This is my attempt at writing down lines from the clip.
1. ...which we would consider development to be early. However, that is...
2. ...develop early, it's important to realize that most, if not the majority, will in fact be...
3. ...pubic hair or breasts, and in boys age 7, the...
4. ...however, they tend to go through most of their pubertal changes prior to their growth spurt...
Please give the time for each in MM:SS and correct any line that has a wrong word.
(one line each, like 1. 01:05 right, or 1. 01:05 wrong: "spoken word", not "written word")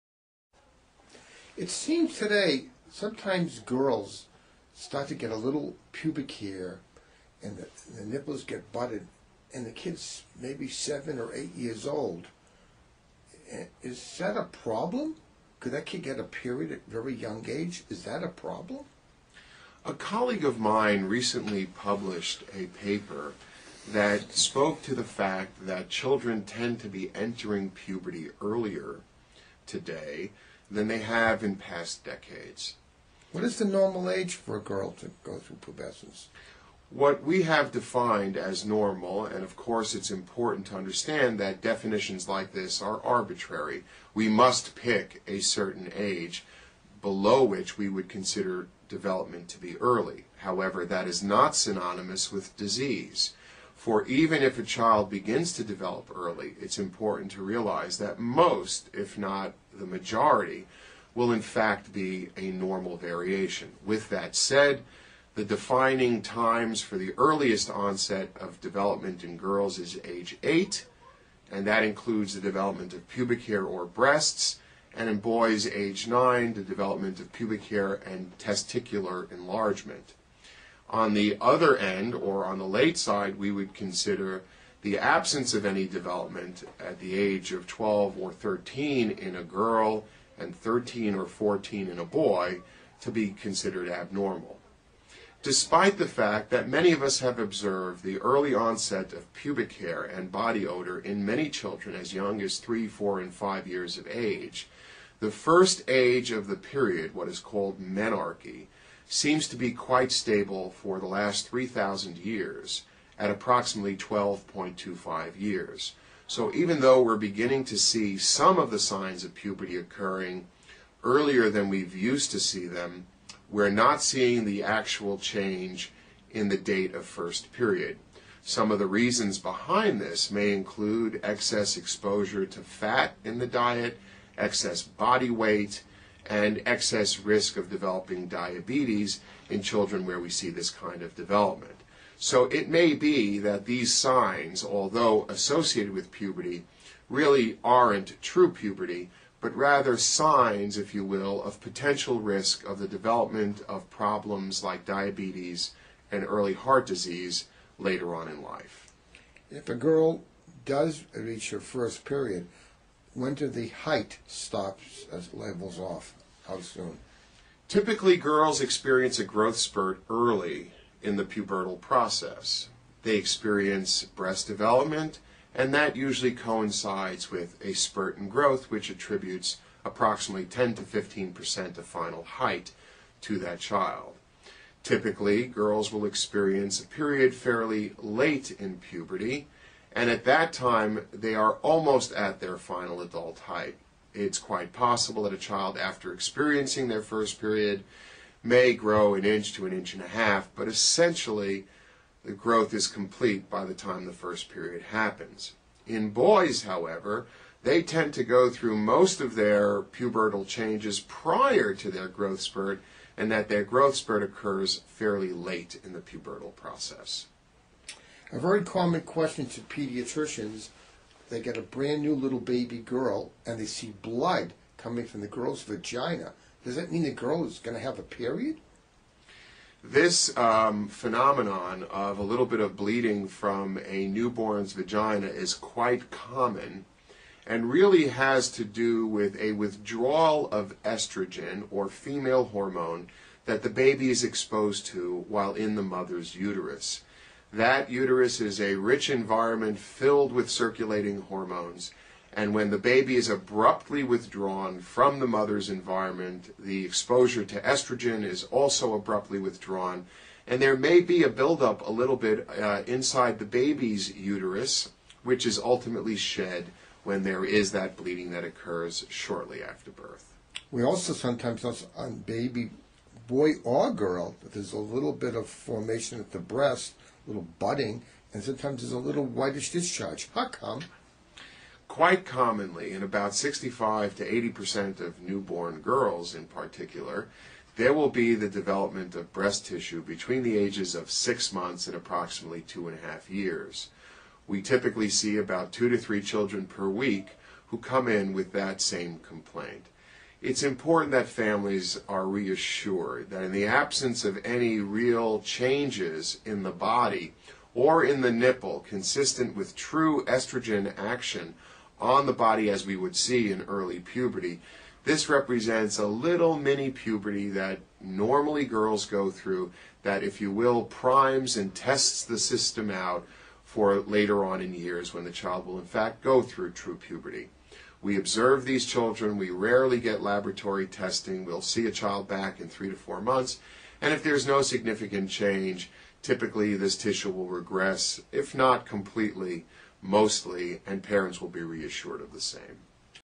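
1. 00:47 right
2. 00:55 right
3. 01:13 wrong: "9", not "7"
4. 03:26 right.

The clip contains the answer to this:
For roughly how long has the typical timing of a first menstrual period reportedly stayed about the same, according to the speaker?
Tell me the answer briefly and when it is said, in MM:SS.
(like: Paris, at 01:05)
3,000 years, at 01:51.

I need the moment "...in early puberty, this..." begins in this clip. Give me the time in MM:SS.
05:13.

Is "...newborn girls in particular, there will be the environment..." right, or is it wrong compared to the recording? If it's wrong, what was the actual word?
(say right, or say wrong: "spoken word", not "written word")
wrong: "development", not "environment".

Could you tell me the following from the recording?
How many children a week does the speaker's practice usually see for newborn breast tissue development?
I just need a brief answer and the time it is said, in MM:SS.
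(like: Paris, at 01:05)
2 to 3, at 04:55.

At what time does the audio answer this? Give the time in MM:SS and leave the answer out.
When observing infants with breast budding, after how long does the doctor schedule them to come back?
05:32.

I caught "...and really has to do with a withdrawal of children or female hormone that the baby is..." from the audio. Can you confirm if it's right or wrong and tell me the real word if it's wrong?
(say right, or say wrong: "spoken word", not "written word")
wrong: "estrogen", not "children".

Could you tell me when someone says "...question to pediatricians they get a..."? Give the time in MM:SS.
03:39.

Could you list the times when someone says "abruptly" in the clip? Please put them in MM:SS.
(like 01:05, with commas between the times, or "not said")
04:13, 04:18.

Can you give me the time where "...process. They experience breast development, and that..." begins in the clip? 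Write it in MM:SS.
02:51.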